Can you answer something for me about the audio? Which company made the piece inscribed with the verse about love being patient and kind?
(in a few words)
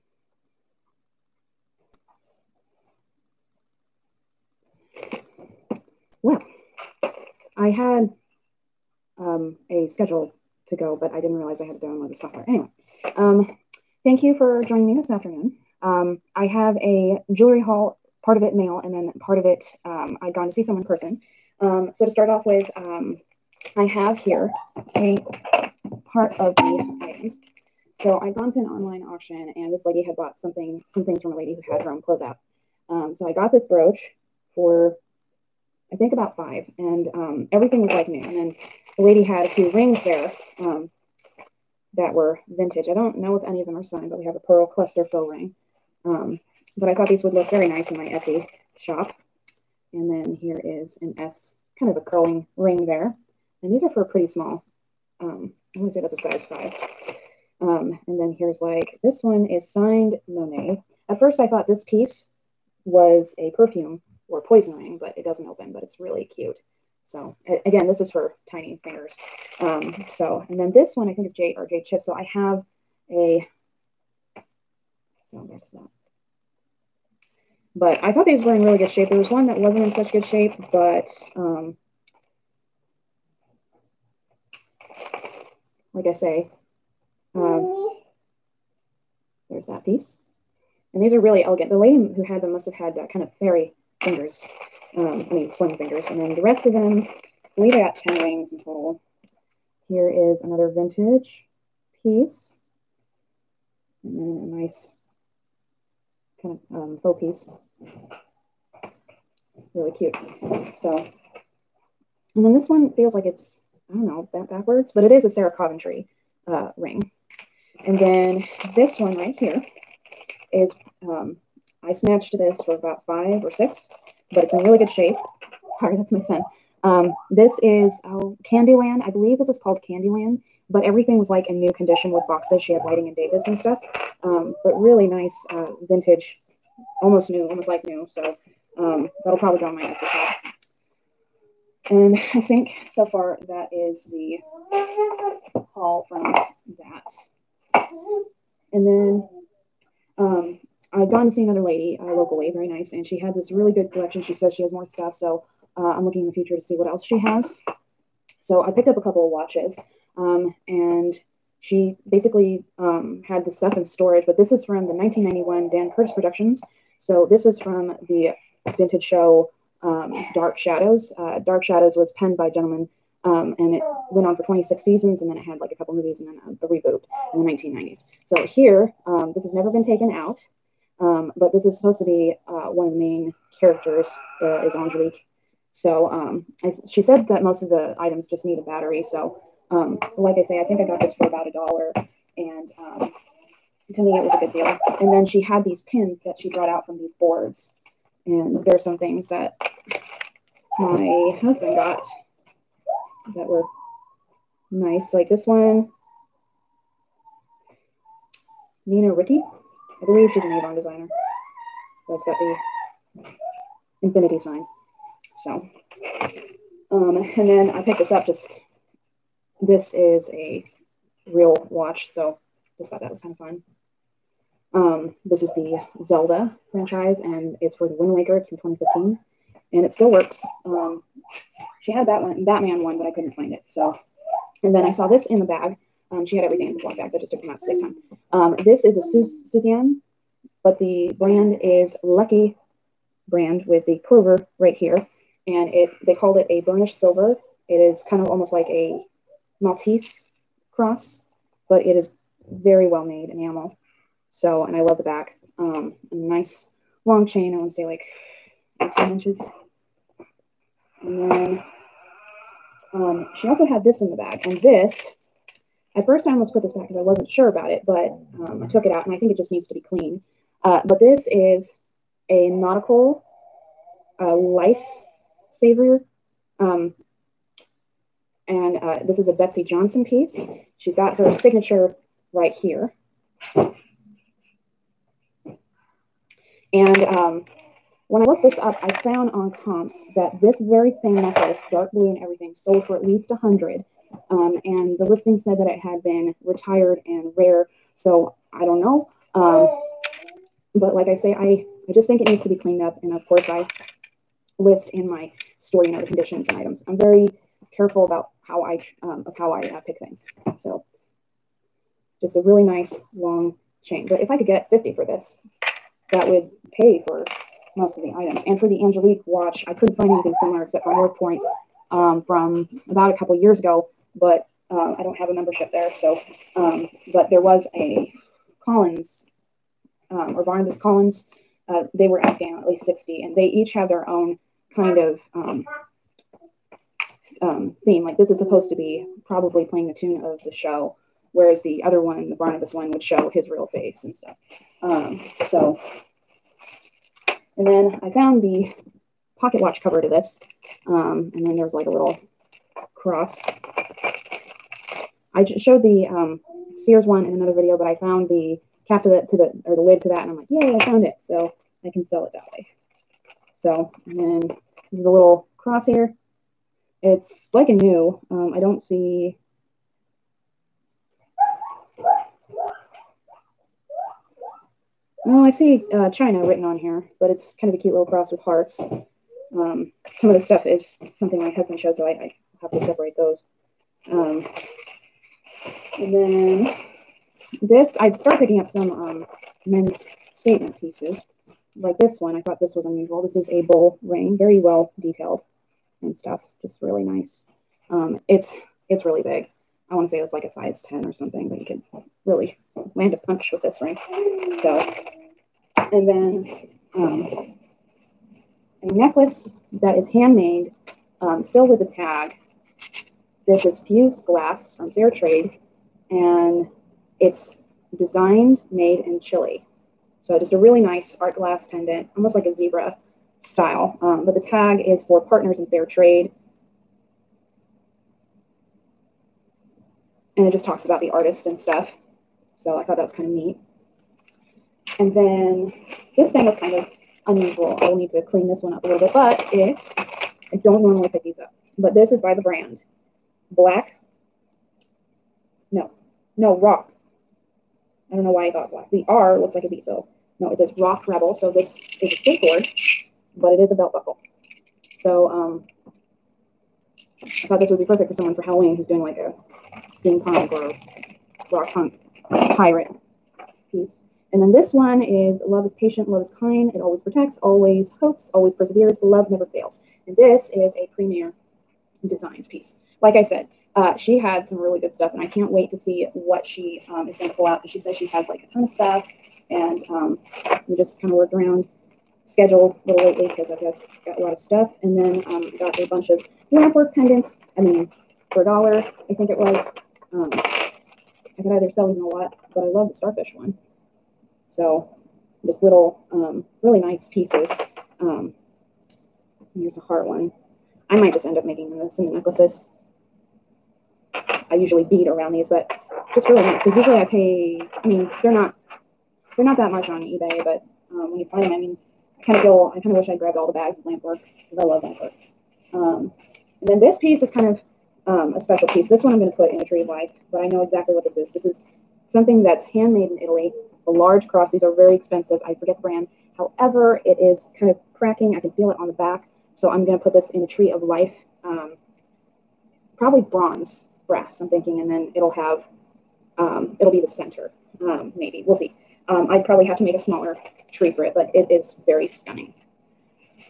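Premier Designs.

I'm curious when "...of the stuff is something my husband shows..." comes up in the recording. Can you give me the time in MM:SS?
06:20.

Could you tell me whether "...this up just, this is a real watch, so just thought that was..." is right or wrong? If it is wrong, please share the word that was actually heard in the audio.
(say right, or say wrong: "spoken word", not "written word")
right.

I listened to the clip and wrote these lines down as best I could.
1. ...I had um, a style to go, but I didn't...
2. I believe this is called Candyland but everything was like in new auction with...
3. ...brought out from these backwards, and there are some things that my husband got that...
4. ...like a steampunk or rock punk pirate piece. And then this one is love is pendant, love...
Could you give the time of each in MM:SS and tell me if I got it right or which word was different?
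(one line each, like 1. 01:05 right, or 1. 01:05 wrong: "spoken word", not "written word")
1. 00:07 wrong: "schedule", not "style"
2. 02:09 wrong: "condition", not "auction"
3. 03:16 wrong: "boards", not "backwards"
4. 07:39 wrong: "patient", not "pendant".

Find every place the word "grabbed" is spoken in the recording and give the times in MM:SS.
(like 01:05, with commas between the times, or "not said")
08:33.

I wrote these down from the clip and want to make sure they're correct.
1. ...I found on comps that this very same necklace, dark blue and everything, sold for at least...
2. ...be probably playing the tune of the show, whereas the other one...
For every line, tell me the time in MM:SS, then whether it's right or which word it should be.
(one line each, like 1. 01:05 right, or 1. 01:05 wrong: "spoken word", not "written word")
1. 04:48 right
2. 05:38 right.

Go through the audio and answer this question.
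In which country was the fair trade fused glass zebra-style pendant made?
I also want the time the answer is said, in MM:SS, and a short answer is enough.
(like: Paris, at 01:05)
Chile, at 06:59.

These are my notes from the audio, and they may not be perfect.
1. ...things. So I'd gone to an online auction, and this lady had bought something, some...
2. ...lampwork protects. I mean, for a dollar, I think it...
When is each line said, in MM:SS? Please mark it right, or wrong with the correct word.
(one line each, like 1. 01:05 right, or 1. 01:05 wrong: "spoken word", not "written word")
1. 00:27 right
2. 08:06 wrong: "pendants", not "protects".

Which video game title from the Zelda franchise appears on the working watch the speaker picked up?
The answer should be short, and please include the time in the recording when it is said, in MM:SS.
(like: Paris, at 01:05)
Wind Waker, at 03:47.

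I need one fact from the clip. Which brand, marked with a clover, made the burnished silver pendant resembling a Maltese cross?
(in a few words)
Lucky brand.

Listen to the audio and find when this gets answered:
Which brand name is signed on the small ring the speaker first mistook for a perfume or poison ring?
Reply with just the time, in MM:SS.
01:00.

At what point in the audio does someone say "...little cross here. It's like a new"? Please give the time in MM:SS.
06:05.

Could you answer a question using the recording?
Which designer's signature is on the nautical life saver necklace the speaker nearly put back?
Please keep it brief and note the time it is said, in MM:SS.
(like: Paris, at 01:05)
Betsey Johnson, at 04:39.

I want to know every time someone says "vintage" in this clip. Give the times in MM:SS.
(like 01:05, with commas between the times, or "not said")
00:42, 01:40, 02:15, 02:48.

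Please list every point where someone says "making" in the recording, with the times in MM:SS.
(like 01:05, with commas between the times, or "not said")
08:21.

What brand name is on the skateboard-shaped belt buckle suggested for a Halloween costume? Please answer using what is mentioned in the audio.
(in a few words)
Rock Rebel.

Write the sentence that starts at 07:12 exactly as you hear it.
So I thought that was kind of neat.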